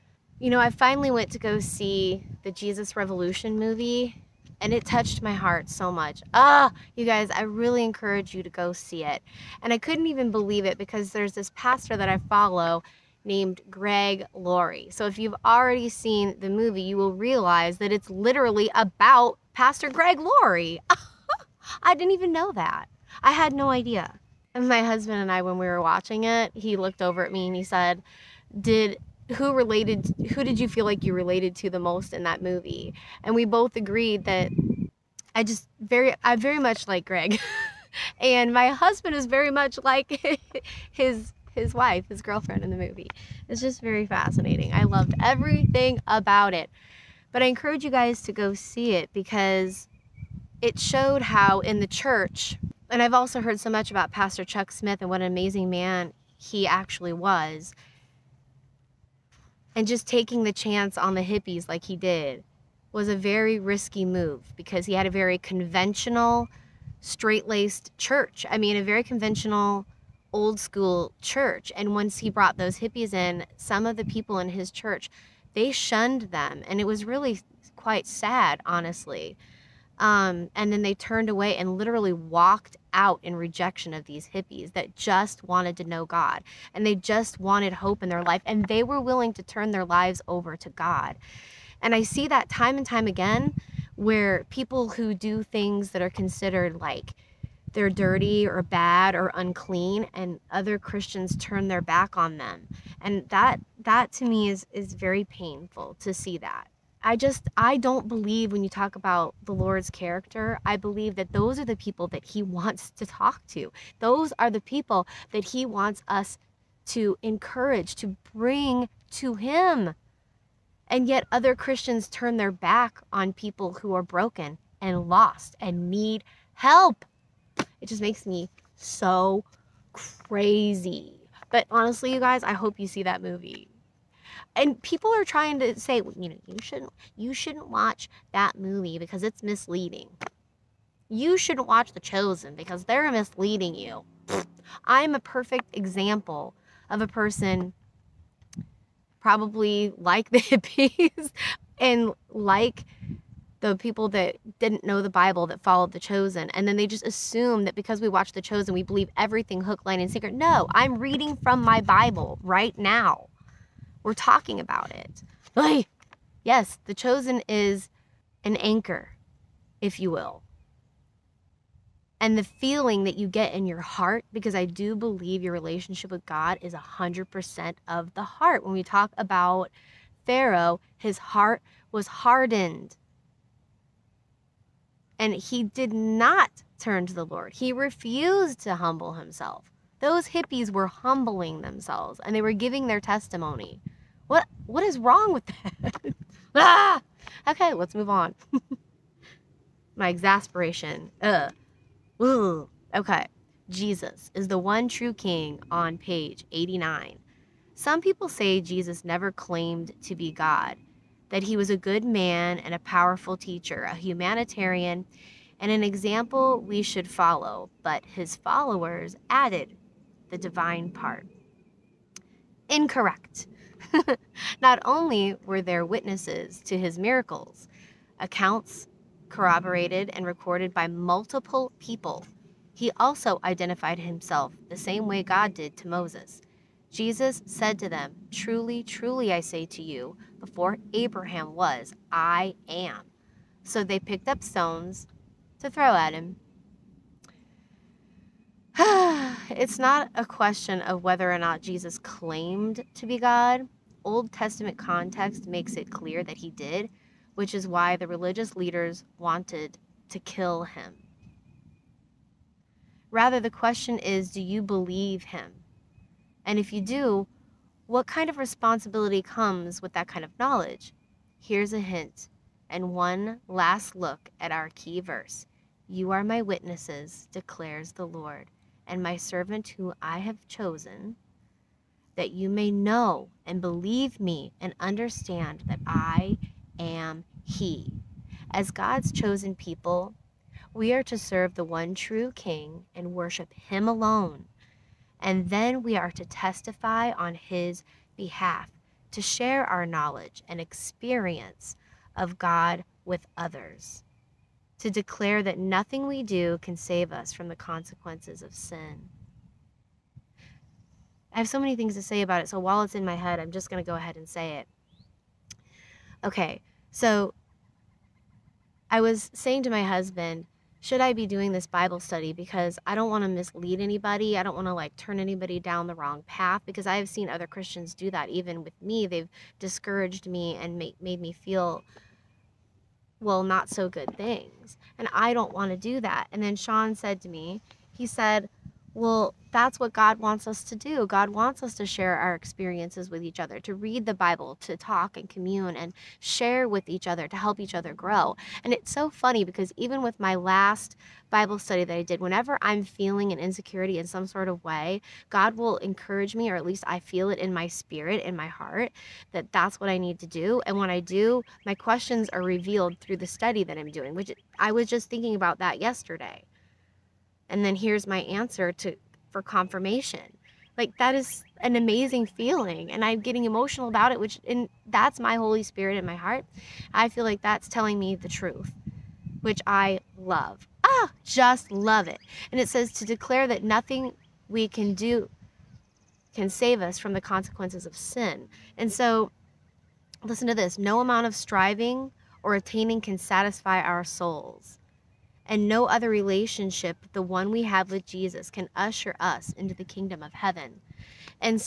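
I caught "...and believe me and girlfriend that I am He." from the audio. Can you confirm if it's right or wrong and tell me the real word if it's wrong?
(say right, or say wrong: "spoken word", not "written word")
wrong: "understand", not "girlfriend".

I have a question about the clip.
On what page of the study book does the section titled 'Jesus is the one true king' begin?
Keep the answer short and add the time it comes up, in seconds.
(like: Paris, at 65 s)
89, at 205 s.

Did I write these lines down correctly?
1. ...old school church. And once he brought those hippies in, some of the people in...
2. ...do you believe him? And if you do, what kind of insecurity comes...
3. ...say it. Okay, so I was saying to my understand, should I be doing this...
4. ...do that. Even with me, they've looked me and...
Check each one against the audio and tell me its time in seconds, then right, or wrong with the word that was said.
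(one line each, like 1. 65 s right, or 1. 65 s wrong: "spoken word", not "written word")
1. 70 s right
2. 264 s wrong: "responsibility", not "insecurity"
3. 314 s wrong: "husband", not "understand"
4. 327 s wrong: "discouraged", not "looked".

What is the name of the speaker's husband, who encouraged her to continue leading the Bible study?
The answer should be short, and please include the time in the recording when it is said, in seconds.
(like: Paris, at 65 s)
Sean, at 336 s.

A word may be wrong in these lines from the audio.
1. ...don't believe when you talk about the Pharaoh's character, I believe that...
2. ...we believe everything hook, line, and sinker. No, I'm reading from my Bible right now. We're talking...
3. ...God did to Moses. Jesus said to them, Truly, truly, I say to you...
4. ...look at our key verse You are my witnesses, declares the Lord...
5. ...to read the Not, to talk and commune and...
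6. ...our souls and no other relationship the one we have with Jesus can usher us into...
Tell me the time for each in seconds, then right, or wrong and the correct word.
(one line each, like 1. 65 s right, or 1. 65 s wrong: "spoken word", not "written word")
1. 107 s wrong: "Lord", not "Pharaoh"
2. 158 s right
3. 235 s right
4. 273 s right
5. 343 s wrong: "Bible", not "Not"
6. 393 s right.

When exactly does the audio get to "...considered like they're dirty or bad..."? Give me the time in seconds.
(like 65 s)
96 s.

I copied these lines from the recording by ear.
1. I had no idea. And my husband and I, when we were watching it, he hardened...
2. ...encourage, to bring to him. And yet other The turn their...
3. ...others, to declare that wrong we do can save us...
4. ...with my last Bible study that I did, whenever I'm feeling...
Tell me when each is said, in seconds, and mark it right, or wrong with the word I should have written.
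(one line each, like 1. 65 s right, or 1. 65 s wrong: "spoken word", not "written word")
1. 23 s wrong: "looked", not "hardened"
2. 117 s wrong: "Christians", not "The"
3. 303 s wrong: "nothing", not "wrong"
4. 350 s right.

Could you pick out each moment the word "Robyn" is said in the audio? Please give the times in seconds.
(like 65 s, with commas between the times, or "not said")
not said.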